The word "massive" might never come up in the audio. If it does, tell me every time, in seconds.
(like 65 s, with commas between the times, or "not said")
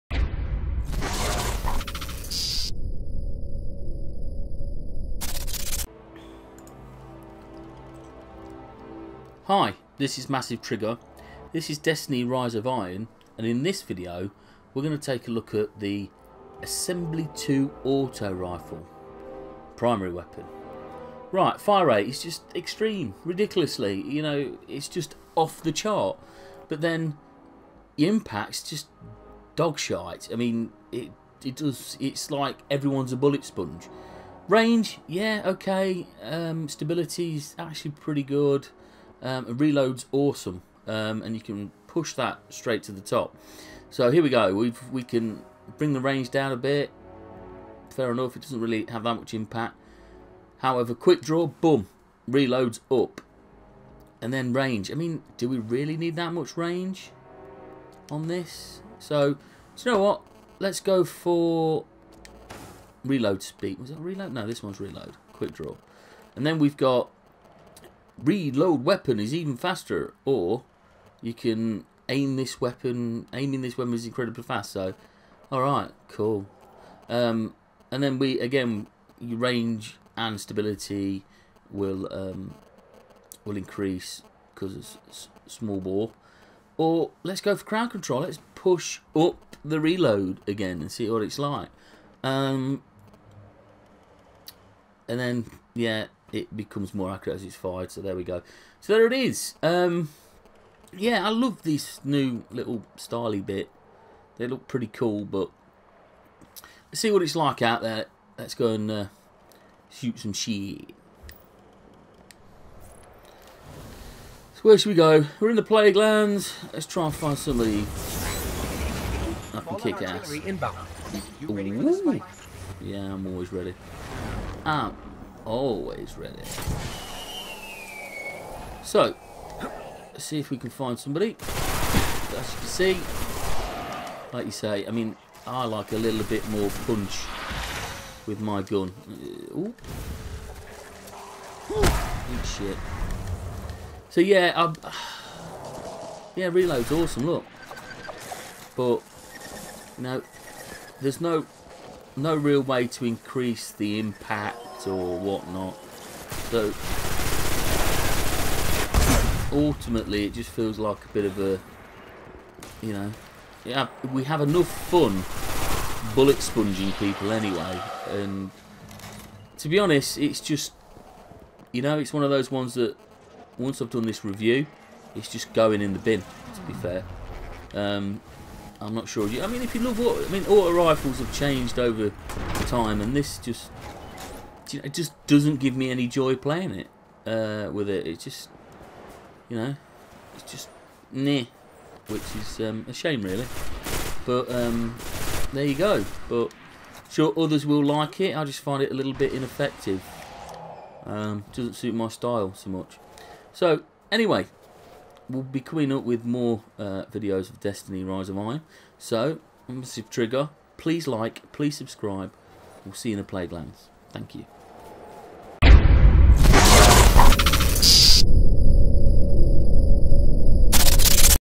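10 s, 209 s.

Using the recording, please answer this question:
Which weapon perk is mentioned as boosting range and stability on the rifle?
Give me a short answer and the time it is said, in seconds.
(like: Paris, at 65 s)
Small bore, at 85 s.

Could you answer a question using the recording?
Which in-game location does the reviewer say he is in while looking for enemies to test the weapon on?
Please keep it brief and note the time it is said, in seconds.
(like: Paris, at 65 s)
Plaguelands, at 115 s.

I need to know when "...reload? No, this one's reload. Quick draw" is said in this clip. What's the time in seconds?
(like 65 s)
63 s.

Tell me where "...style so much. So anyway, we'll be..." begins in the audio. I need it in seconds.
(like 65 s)
202 s.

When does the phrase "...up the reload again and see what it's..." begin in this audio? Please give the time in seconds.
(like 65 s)
89 s.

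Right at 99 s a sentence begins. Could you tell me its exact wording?
Um, yeah, I love this new little styly bit.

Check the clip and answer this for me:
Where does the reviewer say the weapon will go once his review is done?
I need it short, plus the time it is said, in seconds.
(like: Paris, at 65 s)
In the bin, at 175 s.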